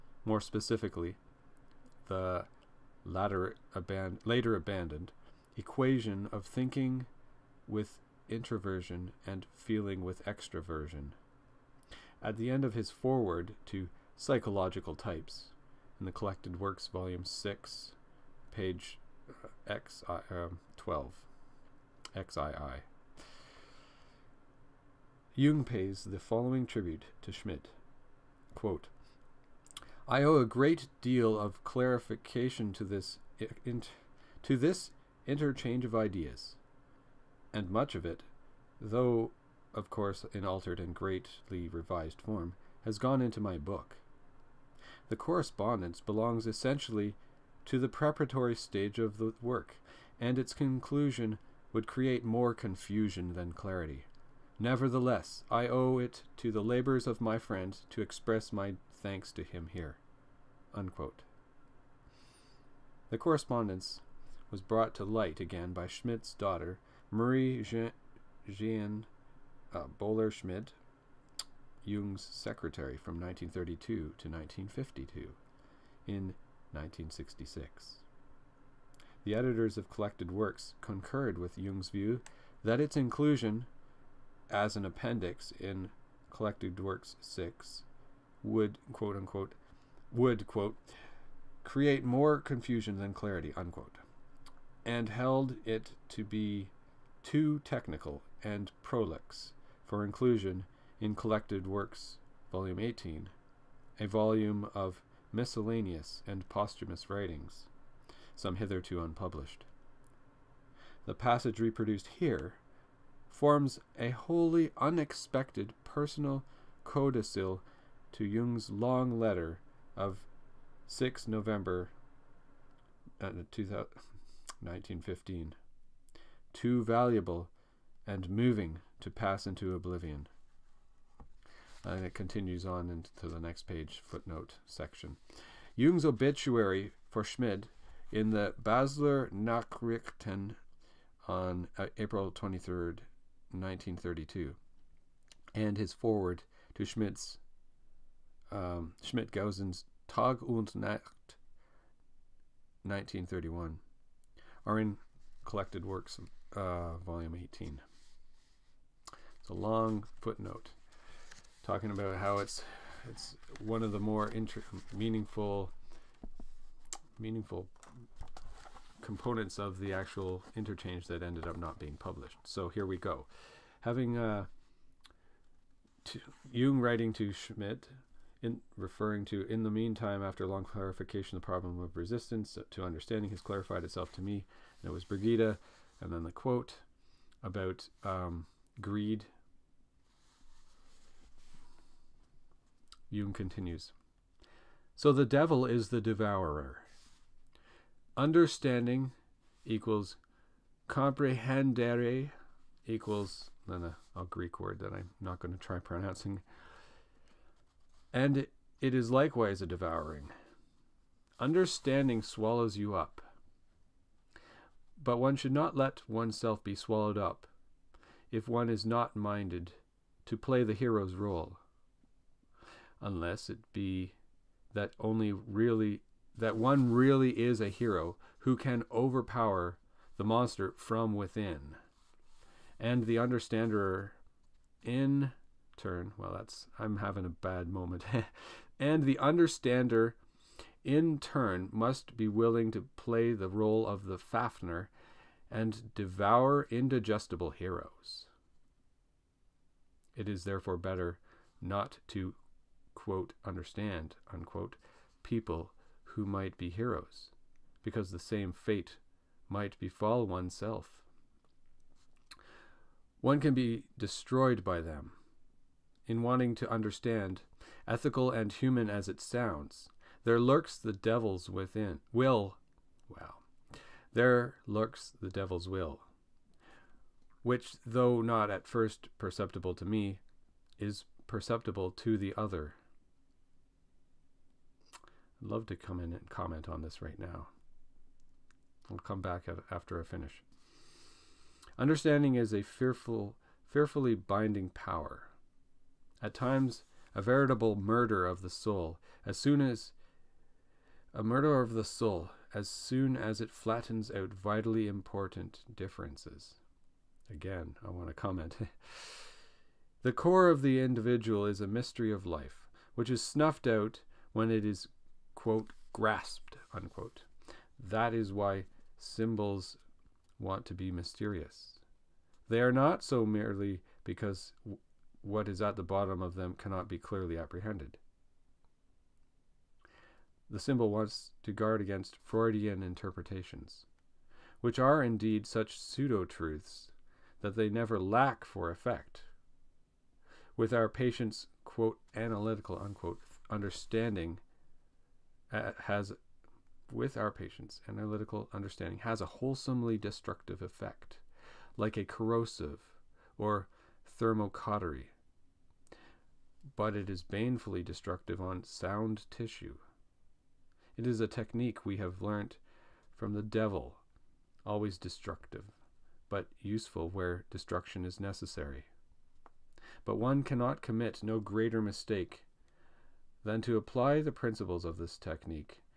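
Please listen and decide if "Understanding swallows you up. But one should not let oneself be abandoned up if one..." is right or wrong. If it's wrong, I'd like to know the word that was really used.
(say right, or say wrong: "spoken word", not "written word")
wrong: "swallowed", not "abandoned".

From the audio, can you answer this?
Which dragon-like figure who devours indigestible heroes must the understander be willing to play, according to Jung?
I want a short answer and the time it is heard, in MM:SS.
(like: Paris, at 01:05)
Fafner, at 04:04.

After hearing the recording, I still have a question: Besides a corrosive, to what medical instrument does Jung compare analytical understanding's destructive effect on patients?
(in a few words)
thermocautery.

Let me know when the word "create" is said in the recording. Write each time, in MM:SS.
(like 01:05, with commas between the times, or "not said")
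00:51, 01:31.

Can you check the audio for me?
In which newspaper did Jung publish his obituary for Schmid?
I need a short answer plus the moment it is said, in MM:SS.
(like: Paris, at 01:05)
Basler Nachrichten, at 02:18.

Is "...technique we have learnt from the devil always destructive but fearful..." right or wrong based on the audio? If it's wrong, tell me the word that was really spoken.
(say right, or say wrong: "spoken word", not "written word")
wrong: "useful", not "fearful".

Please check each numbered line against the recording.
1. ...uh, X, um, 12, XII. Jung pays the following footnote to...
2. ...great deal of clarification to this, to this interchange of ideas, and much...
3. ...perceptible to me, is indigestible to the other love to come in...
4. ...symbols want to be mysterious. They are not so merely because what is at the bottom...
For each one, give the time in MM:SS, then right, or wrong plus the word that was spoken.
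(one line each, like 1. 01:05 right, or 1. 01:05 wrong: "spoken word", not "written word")
1. 00:19 wrong: "tribute", not "footnote"
2. 00:30 right
3. 04:39 wrong: "perceptible", not "indigestible"
4. 05:18 right.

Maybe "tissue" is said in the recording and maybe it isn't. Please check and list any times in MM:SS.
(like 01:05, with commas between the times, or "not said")
05:59.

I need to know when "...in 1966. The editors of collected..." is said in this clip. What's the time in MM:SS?
01:16.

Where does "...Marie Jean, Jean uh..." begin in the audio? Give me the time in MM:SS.
01:07.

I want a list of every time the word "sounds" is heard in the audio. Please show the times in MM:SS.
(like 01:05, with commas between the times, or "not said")
04:29, 05:58.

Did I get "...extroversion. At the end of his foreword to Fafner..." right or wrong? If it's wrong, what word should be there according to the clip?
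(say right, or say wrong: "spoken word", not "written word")
wrong: "Psychological", not "Fafner".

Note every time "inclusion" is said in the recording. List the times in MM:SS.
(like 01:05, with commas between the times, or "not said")
01:22, 01:40.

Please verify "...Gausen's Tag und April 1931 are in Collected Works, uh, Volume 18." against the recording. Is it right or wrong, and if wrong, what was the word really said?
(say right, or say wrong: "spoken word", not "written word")
wrong: "Nacht", not "April".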